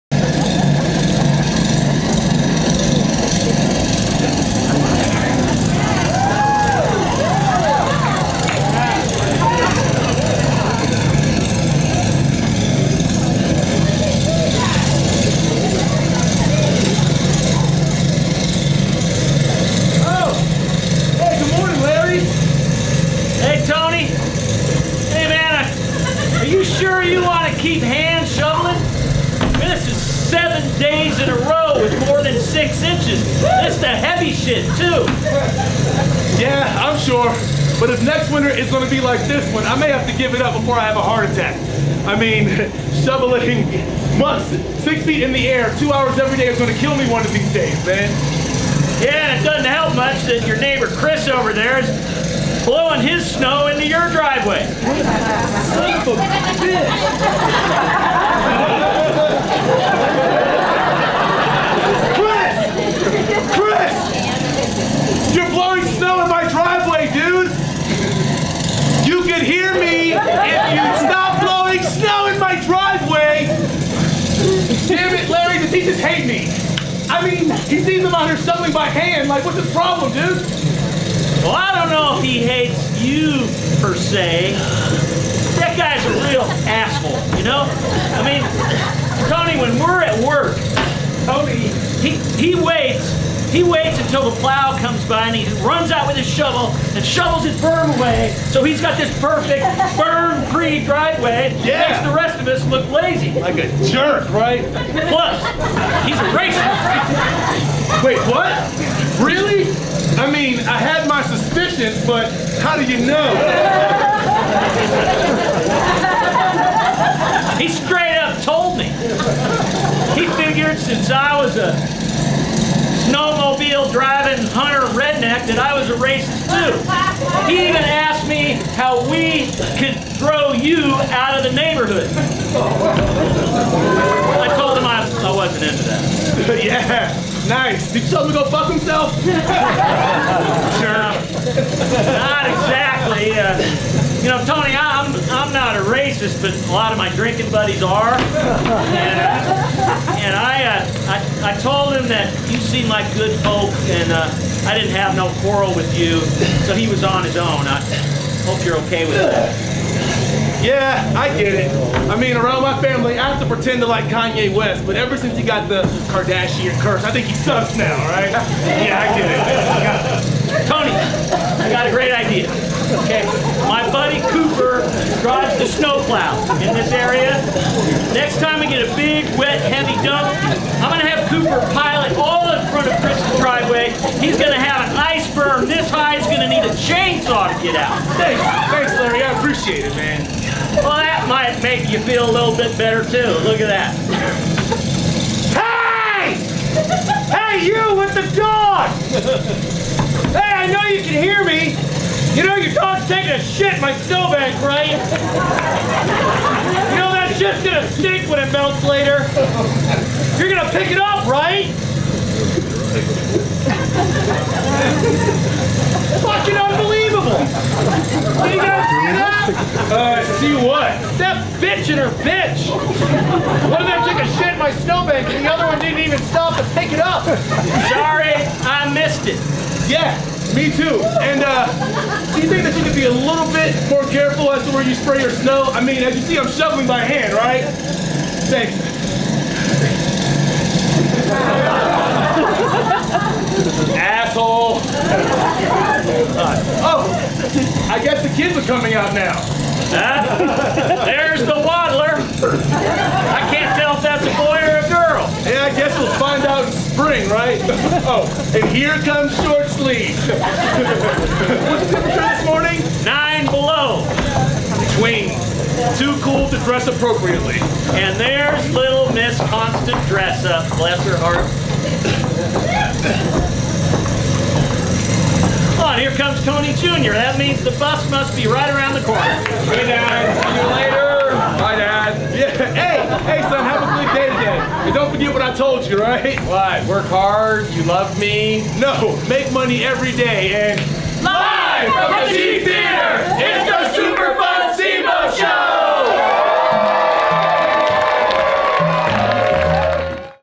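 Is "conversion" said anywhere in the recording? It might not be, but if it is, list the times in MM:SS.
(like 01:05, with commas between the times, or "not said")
not said.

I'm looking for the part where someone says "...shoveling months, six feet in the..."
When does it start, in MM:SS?
00:43.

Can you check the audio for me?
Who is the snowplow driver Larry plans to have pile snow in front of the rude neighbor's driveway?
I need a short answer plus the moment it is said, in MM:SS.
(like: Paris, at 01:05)
Cooper, at 03:01.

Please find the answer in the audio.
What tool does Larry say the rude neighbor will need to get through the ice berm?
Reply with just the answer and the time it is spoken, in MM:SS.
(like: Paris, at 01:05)
chainsaw, at 03:06.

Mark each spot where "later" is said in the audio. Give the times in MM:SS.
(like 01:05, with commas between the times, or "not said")
03:28, 04:40.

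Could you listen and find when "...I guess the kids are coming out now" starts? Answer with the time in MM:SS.
04:07.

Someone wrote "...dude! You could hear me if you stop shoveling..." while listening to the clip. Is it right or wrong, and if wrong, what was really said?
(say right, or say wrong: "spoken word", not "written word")
wrong: "blowing", not "shoveling".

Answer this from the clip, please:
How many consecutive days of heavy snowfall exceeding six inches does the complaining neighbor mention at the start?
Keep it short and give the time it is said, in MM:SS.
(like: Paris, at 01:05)
7, at 00:30.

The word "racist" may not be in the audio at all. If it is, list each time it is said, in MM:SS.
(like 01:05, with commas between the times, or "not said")
01:46, 02:05, 02:25.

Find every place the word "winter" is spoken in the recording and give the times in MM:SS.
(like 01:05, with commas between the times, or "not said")
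00:38.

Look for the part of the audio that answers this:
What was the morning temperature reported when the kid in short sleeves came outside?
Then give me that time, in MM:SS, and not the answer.
04:23.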